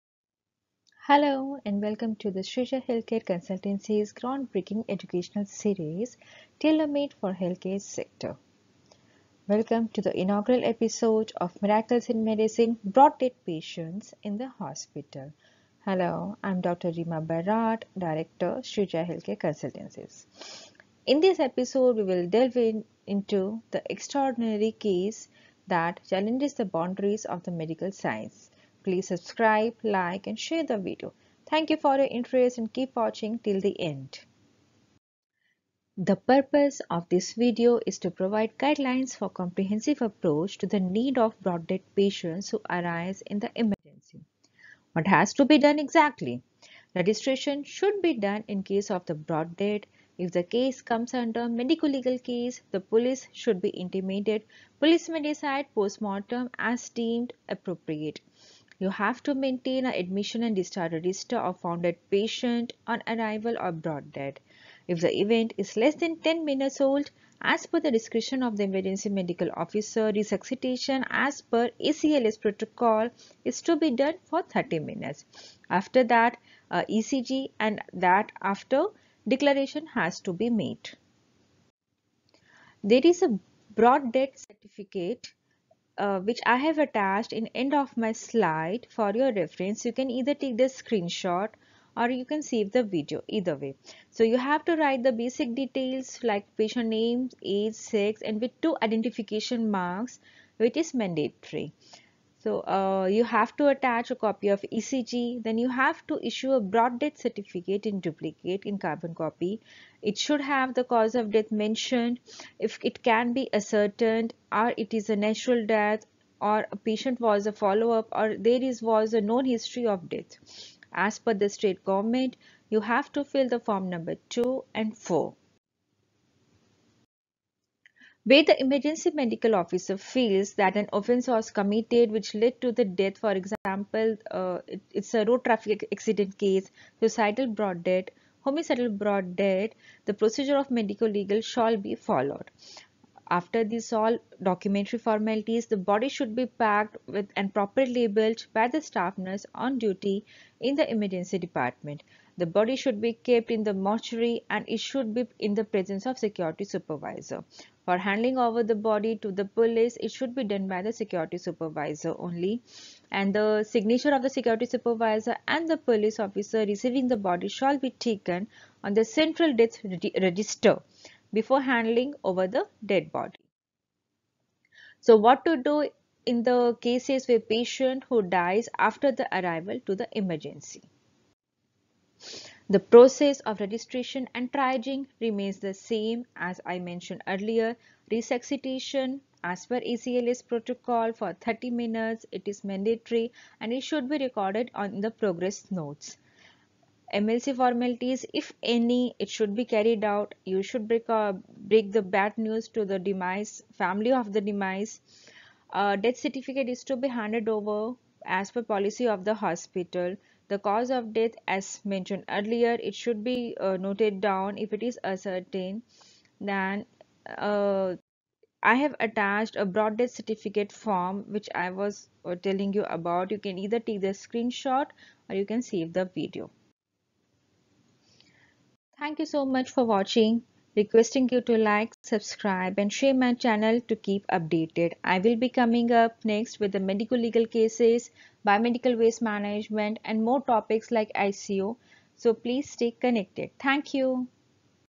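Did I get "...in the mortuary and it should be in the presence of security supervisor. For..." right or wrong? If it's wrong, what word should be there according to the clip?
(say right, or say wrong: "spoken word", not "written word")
right.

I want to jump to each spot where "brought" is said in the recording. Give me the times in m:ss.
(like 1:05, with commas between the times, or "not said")
0:12, 0:41, 0:49, 1:03.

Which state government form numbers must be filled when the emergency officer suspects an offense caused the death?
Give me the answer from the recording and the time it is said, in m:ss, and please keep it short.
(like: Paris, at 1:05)
2 and 4, at 2:03.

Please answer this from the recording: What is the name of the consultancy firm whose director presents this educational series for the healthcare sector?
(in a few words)
Shreeja Healthcare Consultancy.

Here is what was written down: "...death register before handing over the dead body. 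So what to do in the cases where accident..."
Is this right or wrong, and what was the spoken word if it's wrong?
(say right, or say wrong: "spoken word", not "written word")
wrong: "patient", not "accident".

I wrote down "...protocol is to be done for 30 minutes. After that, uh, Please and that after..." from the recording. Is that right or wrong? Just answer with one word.
wrong.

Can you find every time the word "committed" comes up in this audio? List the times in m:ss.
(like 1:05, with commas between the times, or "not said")
2:11.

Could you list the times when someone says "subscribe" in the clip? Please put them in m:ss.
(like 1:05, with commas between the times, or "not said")
0:29, 3:52.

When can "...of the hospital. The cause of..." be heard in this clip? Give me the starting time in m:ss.
3:29.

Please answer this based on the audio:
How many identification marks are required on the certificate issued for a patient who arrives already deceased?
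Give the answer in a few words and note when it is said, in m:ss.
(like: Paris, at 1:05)
2, at 1:38.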